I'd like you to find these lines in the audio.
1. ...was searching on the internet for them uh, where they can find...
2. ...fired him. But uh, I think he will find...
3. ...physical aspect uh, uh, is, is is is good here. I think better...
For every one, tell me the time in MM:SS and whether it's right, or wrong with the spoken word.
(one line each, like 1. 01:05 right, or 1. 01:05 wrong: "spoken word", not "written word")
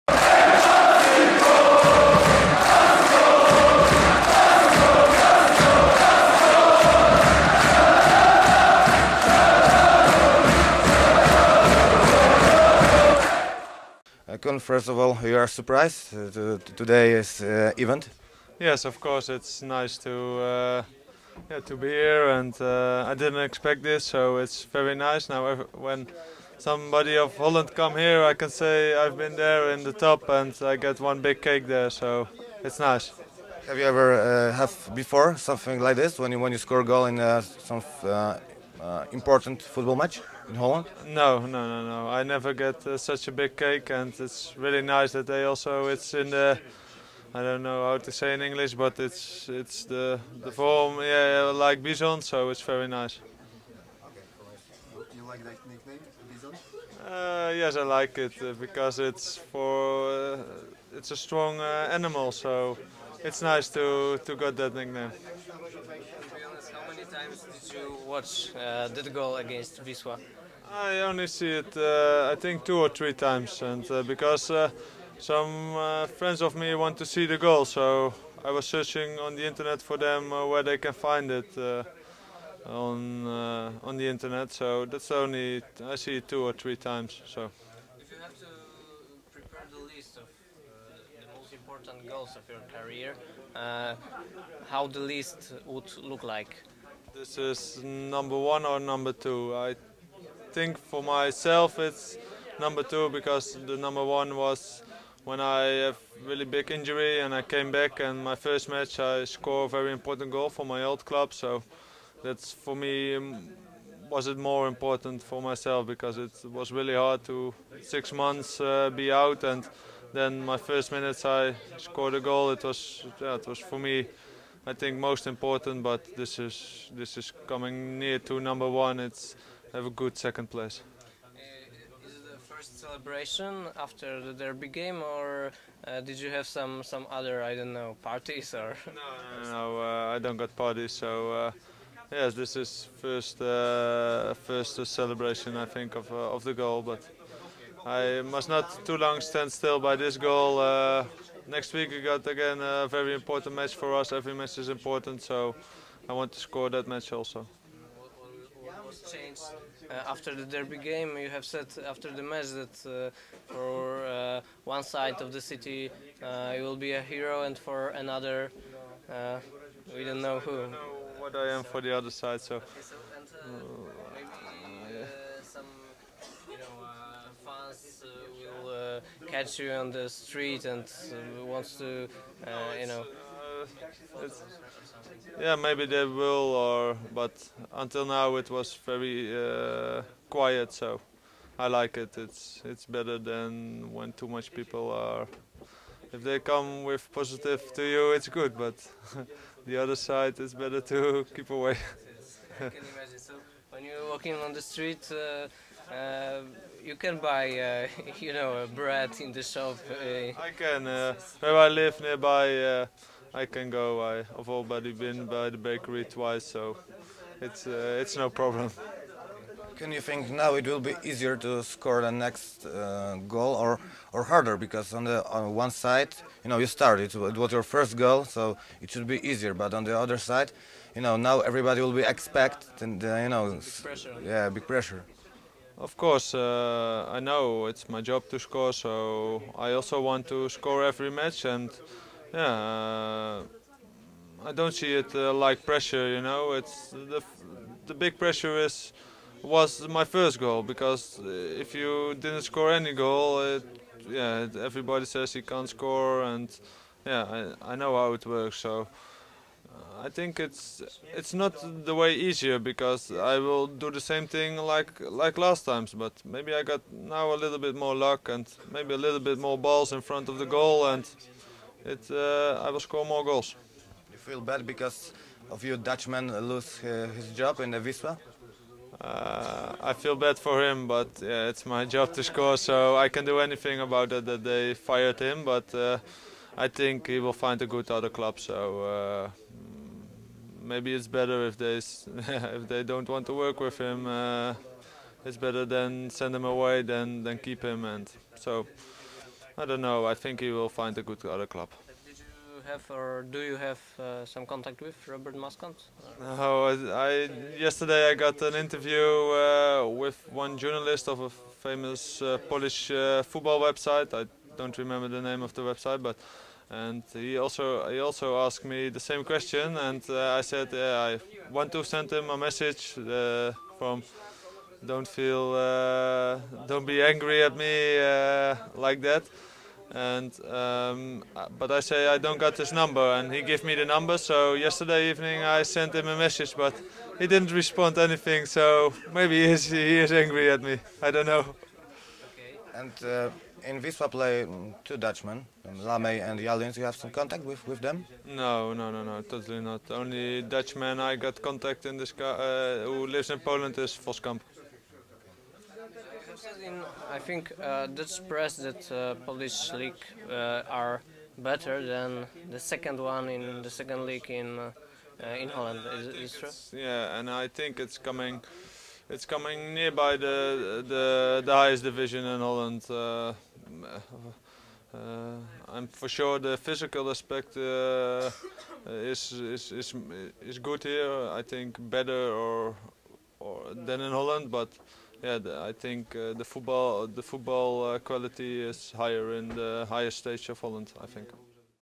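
1. 01:18 right
2. 04:44 right
3. 06:16 right.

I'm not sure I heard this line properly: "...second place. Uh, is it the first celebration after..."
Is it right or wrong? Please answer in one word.
right.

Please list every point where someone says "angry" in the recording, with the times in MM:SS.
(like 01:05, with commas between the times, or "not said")
05:27, 05:40.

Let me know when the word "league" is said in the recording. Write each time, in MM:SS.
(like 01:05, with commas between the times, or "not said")
05:59, 06:04.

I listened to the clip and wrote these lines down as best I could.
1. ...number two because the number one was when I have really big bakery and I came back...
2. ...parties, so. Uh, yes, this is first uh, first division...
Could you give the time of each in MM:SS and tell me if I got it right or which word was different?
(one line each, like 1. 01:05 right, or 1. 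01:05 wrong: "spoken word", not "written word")
1. 01:42 wrong: "injury", not "bakery"
2. 02:20 wrong: "celebration", not "division".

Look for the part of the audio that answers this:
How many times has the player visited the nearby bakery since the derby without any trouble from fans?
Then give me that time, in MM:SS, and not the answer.
03:36.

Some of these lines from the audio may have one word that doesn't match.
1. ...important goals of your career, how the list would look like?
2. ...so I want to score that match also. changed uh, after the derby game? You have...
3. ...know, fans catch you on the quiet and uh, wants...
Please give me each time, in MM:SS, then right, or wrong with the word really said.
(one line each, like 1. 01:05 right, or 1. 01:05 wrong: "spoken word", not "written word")
1. 01:31 right
2. 02:35 right
3. 02:56 wrong: "street", not "quiet".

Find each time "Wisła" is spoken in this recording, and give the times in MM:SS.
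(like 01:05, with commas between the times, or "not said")
01:09, 05:43.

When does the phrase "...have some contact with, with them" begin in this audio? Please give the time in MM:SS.
05:46.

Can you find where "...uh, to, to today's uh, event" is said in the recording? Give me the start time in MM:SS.
00:16.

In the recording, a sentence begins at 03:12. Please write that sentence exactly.
It's it's better than when too much people are.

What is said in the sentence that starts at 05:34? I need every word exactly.
So yesterday evening I sent him a message, but he didn't respond anything.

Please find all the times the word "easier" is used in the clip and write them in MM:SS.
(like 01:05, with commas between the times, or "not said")
03:41, 03:49, 04:22.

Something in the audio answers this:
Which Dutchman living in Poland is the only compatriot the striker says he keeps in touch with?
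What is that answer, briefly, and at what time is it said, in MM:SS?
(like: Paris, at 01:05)
Voskamp, at 05:54.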